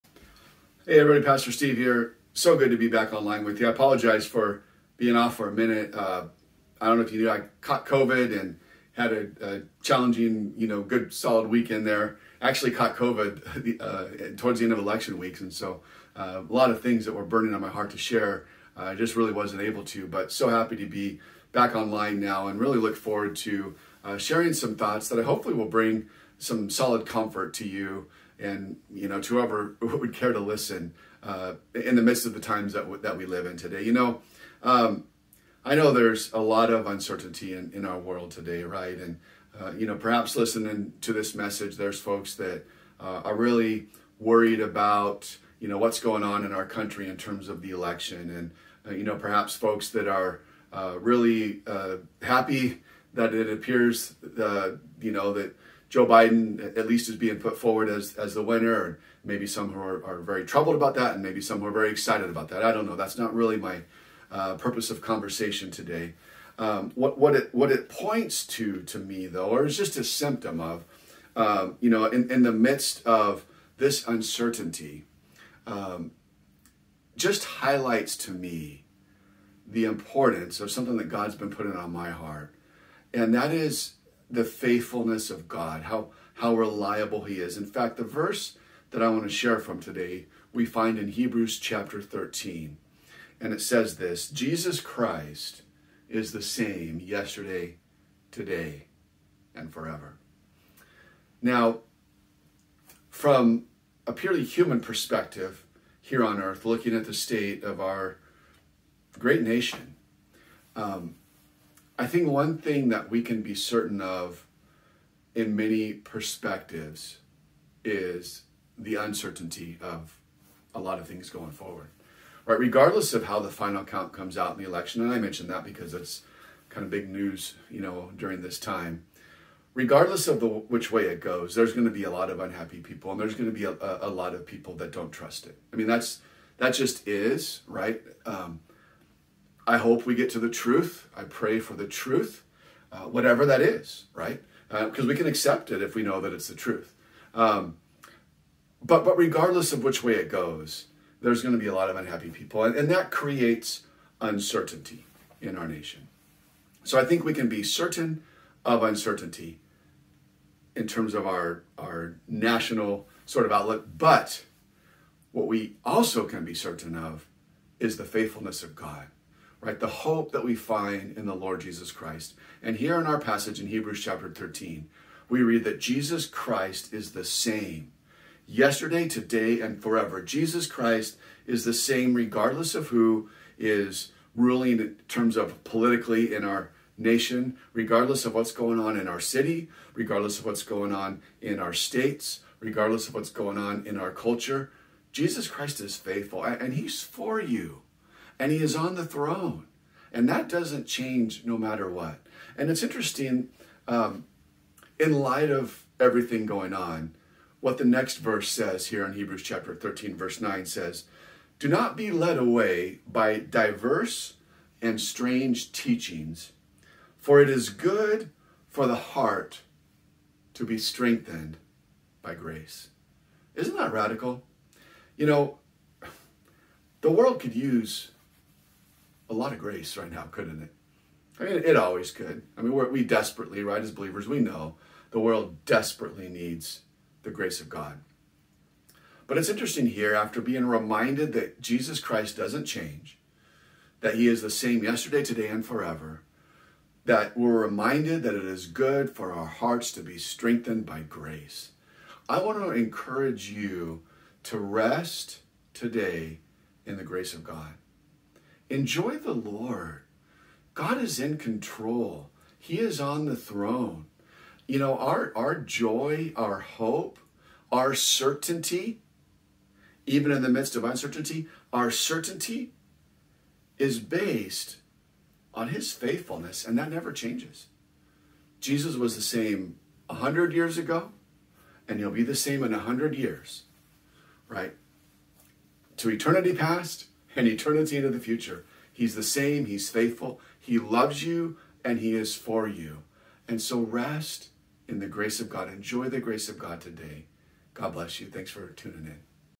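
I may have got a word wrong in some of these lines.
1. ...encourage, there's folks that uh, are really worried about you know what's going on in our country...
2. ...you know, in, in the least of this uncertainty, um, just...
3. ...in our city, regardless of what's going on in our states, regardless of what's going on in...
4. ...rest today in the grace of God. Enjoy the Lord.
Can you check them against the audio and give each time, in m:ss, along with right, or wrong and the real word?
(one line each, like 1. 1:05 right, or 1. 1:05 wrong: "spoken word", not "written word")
1. 0:41 wrong: "message", not "encourage"
2. 1:11 wrong: "midst", not "least"
3. 3:08 right
4. 4:14 right.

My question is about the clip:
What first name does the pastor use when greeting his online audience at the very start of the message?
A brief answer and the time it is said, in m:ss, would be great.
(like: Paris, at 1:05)
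Steve, at 0:01.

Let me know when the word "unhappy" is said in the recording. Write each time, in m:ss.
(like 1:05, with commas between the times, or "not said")
2:12, 2:31.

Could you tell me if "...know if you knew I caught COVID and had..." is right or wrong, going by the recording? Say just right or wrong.
right.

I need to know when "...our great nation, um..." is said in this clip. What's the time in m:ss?
1:47.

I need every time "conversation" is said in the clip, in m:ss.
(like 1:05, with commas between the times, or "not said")
1:05.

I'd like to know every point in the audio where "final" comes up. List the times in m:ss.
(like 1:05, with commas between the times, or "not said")
2:03.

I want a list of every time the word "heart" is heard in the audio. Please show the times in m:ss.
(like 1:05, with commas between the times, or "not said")
0:17, 1:22, 3:38, 4:09.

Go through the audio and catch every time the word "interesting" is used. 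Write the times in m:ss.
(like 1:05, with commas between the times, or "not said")
3:22, 3:59.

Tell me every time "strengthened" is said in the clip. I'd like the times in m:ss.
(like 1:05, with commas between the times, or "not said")
3:40, 4:10.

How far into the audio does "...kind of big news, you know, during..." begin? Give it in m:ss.
2:06.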